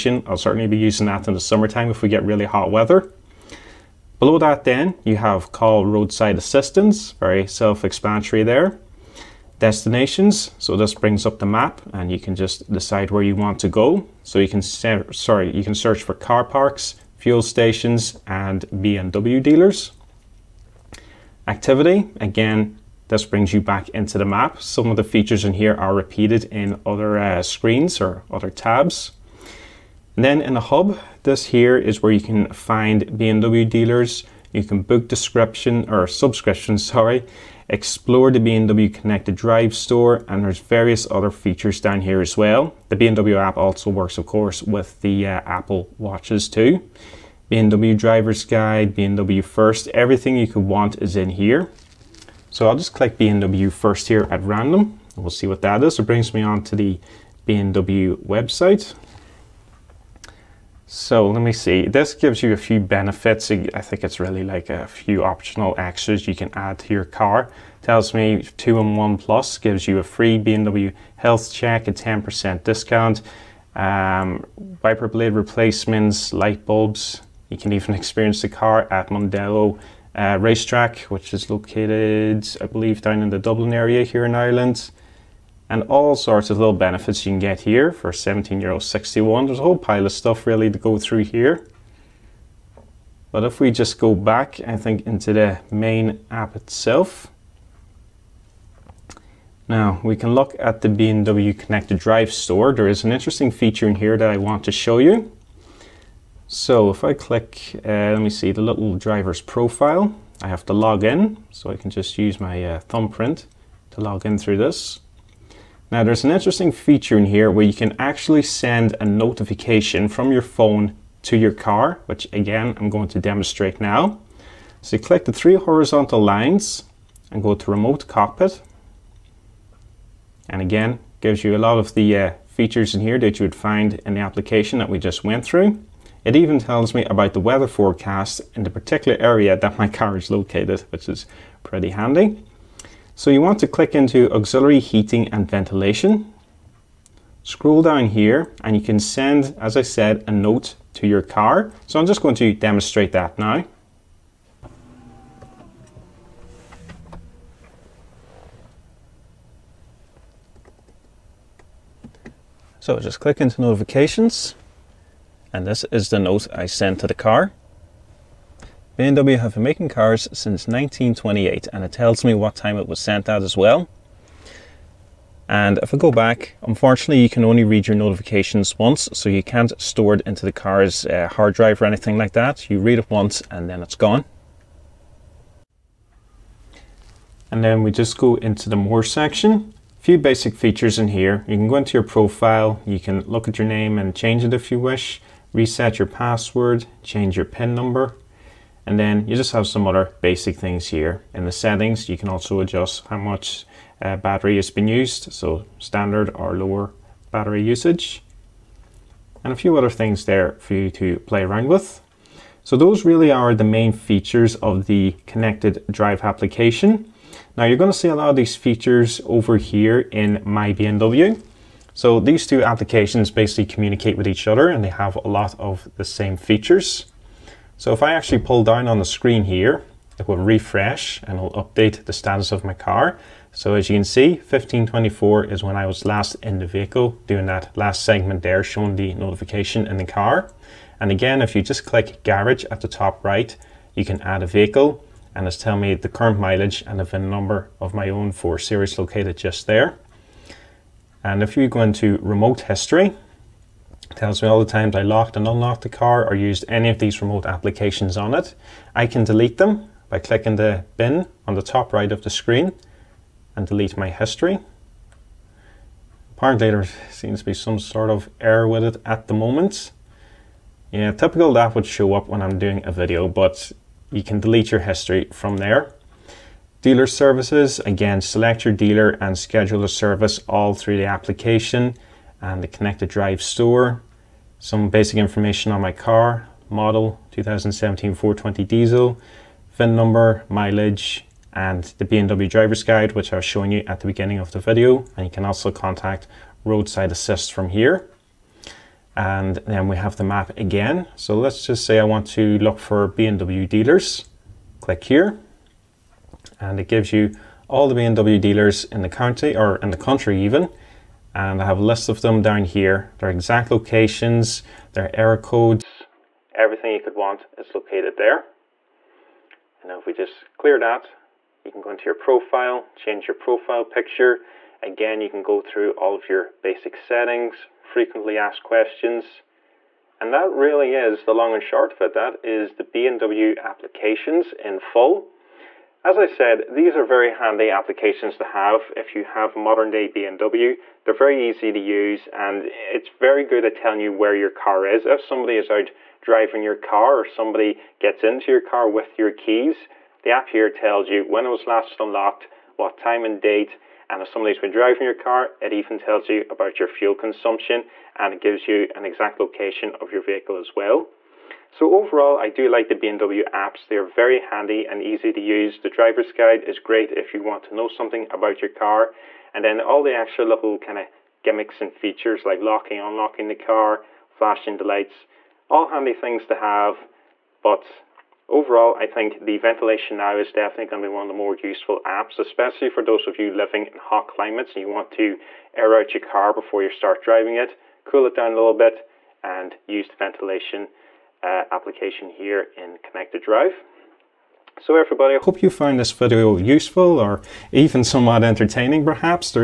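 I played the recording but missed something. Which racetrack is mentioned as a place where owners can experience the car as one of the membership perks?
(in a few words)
Mondello.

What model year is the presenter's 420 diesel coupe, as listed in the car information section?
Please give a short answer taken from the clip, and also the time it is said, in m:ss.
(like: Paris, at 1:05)
2017, at 4:47.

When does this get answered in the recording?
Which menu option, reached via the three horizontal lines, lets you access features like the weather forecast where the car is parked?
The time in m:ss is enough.
2:07.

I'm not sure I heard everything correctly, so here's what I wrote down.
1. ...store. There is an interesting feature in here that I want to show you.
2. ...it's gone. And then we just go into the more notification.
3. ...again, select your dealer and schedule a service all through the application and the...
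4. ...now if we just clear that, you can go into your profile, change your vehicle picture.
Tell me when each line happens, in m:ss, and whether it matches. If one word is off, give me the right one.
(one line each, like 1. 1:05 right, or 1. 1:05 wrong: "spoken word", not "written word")
1. 1:42 right
2. 3:03 wrong: "section", not "notification"
3. 4:37 right
4. 5:19 wrong: "profile", not "vehicle".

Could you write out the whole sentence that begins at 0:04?
Below that then, you have call roadside assistance, very self-explanatory there.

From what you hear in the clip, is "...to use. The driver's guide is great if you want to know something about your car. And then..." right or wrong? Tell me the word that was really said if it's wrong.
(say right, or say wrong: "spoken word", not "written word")
right.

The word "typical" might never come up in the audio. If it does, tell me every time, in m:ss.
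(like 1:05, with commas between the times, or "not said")
4:31.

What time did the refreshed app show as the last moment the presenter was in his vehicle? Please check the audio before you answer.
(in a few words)
15:24.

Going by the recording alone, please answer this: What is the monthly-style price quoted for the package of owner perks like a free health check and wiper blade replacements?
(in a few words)
17 euro 61.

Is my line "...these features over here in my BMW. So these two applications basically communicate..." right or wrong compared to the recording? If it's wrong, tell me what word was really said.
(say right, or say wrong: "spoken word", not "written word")
right.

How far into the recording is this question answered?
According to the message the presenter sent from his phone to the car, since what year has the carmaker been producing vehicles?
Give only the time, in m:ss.
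2:50.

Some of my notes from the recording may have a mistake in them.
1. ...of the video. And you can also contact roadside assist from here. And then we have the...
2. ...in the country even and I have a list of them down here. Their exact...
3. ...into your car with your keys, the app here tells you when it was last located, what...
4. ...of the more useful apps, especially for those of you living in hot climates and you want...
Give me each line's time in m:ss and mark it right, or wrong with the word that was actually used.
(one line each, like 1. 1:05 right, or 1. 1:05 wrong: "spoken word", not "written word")
1. 4:54 right
2. 5:09 right
3. 5:48 wrong: "unlocked", not "located"
4. 6:21 right.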